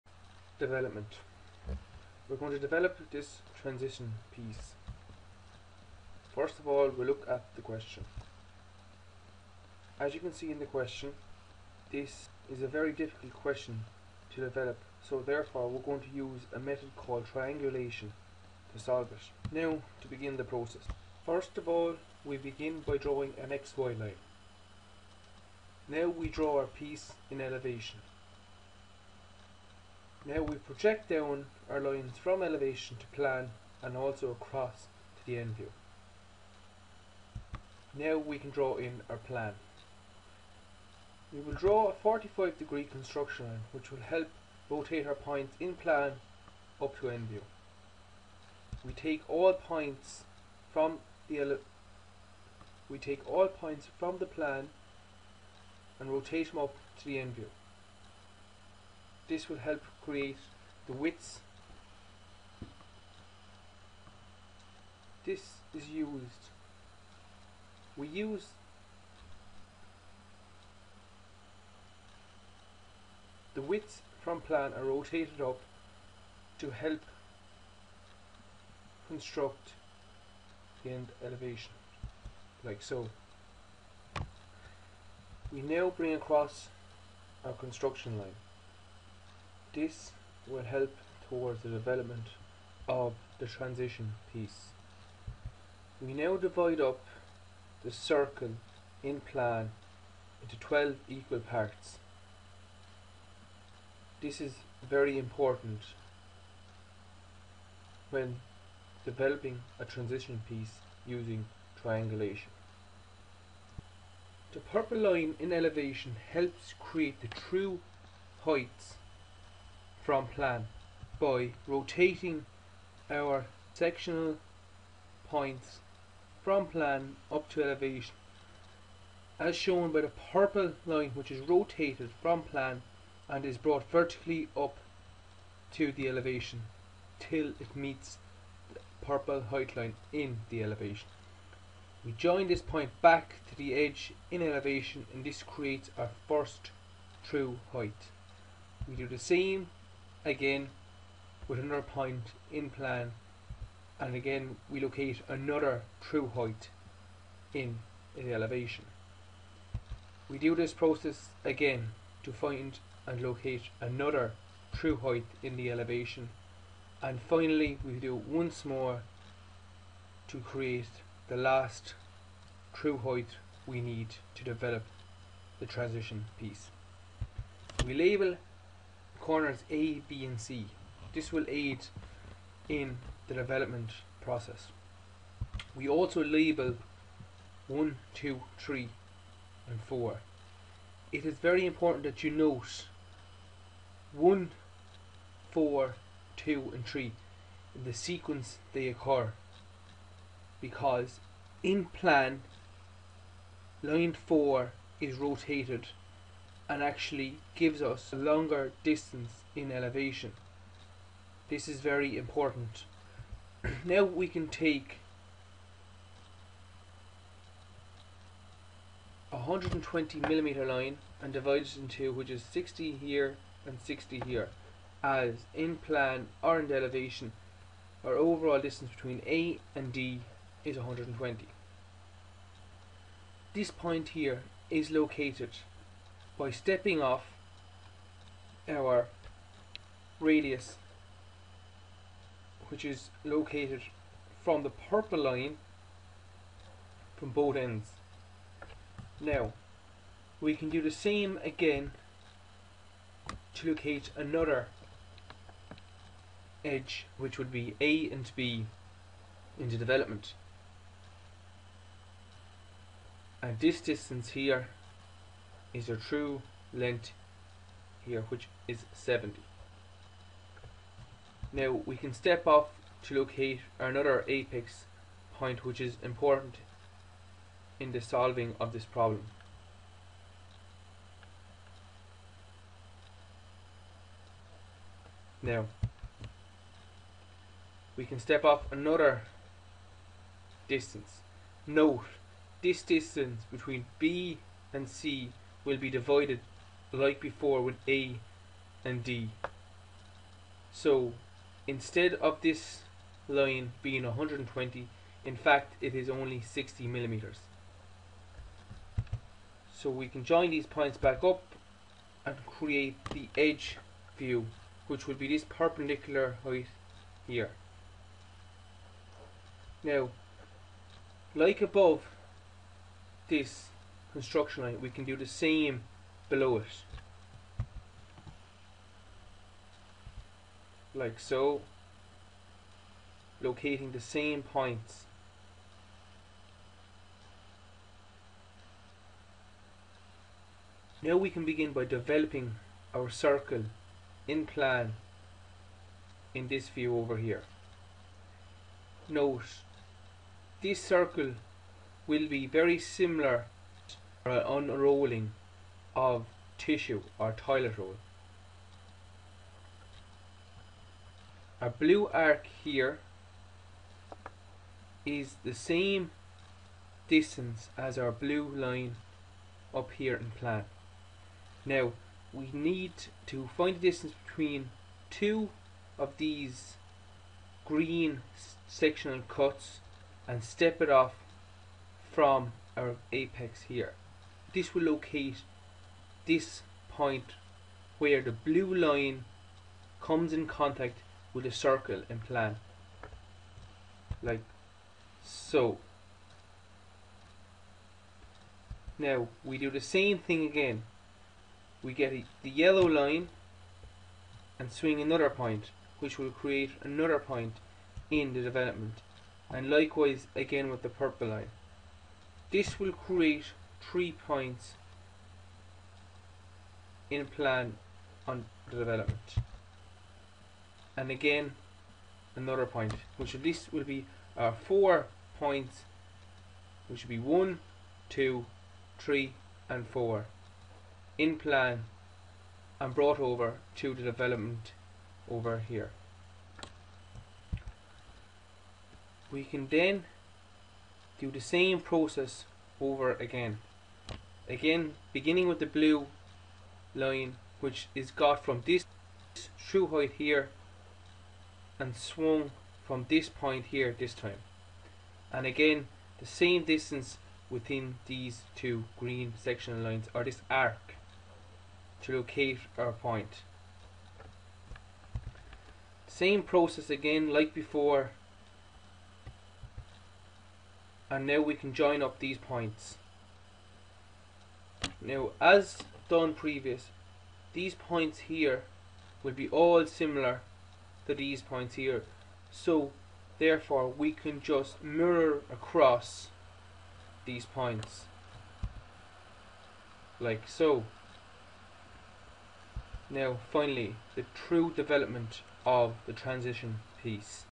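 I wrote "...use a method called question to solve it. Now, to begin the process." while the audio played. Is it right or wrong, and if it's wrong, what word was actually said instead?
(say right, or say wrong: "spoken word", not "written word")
wrong: "triangulation", not "question".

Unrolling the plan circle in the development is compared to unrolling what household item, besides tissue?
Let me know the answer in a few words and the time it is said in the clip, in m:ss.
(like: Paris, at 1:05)
Toilet roll, at 5:57.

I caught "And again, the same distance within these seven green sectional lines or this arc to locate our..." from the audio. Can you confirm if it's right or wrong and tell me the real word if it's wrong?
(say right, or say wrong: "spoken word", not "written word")
wrong: "two", not "seven".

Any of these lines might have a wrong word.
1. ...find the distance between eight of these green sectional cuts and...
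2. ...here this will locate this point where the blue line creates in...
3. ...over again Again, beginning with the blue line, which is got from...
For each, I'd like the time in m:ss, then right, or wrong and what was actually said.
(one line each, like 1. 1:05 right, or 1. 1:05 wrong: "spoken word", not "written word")
1. 6:13 wrong: "two", not "eight"
2. 6:23 wrong: "comes", not "creates"
3. 7:22 right.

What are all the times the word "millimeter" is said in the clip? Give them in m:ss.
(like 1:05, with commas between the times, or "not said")
3:40, 5:06.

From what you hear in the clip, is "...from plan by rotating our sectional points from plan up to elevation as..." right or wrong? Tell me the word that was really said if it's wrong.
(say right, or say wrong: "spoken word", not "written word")
right.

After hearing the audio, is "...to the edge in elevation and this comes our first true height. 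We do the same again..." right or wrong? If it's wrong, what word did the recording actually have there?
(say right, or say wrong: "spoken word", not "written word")
wrong: "creates", not "comes".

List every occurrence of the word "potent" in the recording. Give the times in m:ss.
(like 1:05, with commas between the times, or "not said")
not said.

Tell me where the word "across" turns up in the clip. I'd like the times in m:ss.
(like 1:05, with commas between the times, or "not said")
0:34, 1:26, 8:05.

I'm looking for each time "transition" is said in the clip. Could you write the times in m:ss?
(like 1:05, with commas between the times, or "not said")
0:03, 1:33, 1:49, 2:55, 8:16.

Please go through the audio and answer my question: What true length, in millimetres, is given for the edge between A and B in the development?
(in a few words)
70.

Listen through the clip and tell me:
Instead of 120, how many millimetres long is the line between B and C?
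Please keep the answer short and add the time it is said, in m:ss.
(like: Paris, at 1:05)
60, at 5:06.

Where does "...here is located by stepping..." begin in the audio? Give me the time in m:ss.
3:54.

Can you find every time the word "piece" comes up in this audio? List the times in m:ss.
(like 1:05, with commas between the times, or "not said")
0:04, 0:26, 1:34, 1:50, 2:56, 8:17.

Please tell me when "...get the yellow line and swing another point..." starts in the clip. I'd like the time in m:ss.
6:41.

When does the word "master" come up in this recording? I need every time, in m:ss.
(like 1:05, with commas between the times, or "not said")
not said.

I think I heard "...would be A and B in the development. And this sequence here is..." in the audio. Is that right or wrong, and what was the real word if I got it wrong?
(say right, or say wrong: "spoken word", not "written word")
wrong: "distance", not "sequence".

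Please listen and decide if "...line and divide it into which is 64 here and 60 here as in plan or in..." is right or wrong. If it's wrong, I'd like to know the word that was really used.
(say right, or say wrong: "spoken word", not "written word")
wrong: "60", not "64".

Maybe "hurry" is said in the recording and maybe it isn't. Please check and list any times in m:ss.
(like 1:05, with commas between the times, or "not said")
not said.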